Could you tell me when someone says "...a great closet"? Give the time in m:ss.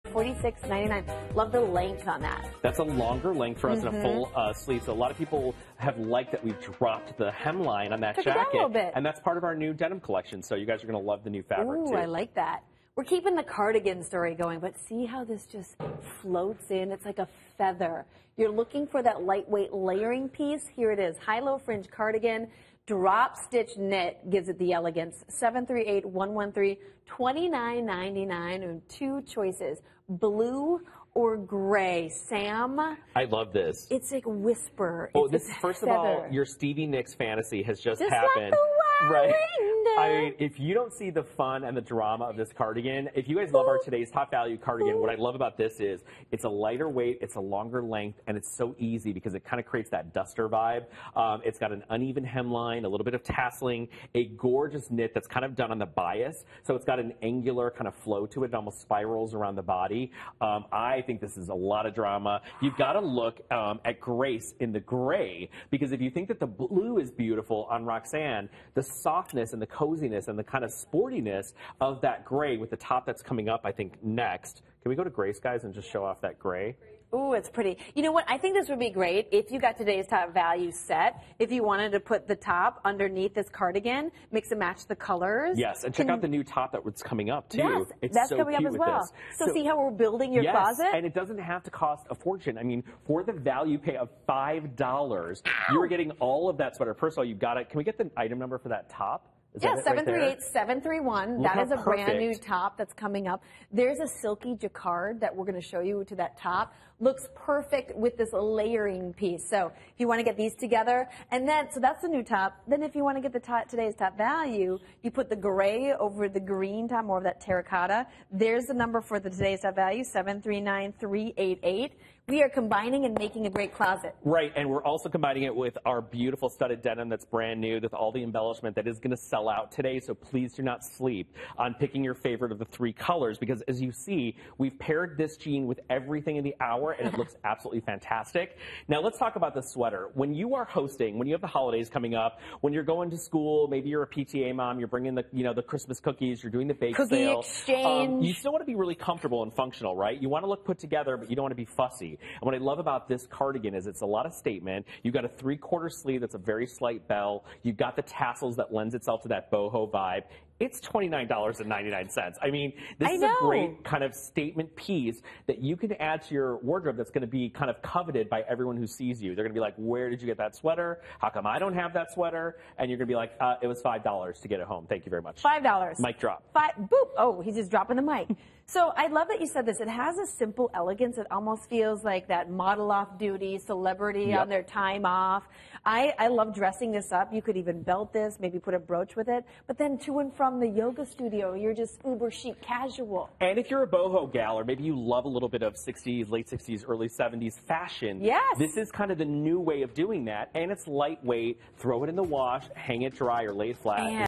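2:03.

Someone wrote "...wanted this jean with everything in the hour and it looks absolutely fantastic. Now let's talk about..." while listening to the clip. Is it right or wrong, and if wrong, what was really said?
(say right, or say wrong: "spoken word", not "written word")
wrong: "paired", not "wanted".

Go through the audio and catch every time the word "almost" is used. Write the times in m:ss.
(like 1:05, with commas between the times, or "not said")
0:58, 3:01.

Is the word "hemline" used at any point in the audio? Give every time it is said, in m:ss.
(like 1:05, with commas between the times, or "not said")
0:07, 0:52.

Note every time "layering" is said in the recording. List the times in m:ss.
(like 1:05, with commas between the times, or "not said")
0:19, 1:48.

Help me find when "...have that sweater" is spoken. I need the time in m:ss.
2:51.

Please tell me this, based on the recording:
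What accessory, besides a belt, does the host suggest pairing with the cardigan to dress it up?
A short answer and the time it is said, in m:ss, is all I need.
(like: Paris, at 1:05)
a brooch, at 3:08.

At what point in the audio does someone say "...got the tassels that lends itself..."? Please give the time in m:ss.
2:37.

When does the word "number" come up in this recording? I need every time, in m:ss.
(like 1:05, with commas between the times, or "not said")
1:38, 1:58.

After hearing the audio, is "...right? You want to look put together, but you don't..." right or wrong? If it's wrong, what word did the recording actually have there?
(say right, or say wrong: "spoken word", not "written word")
right.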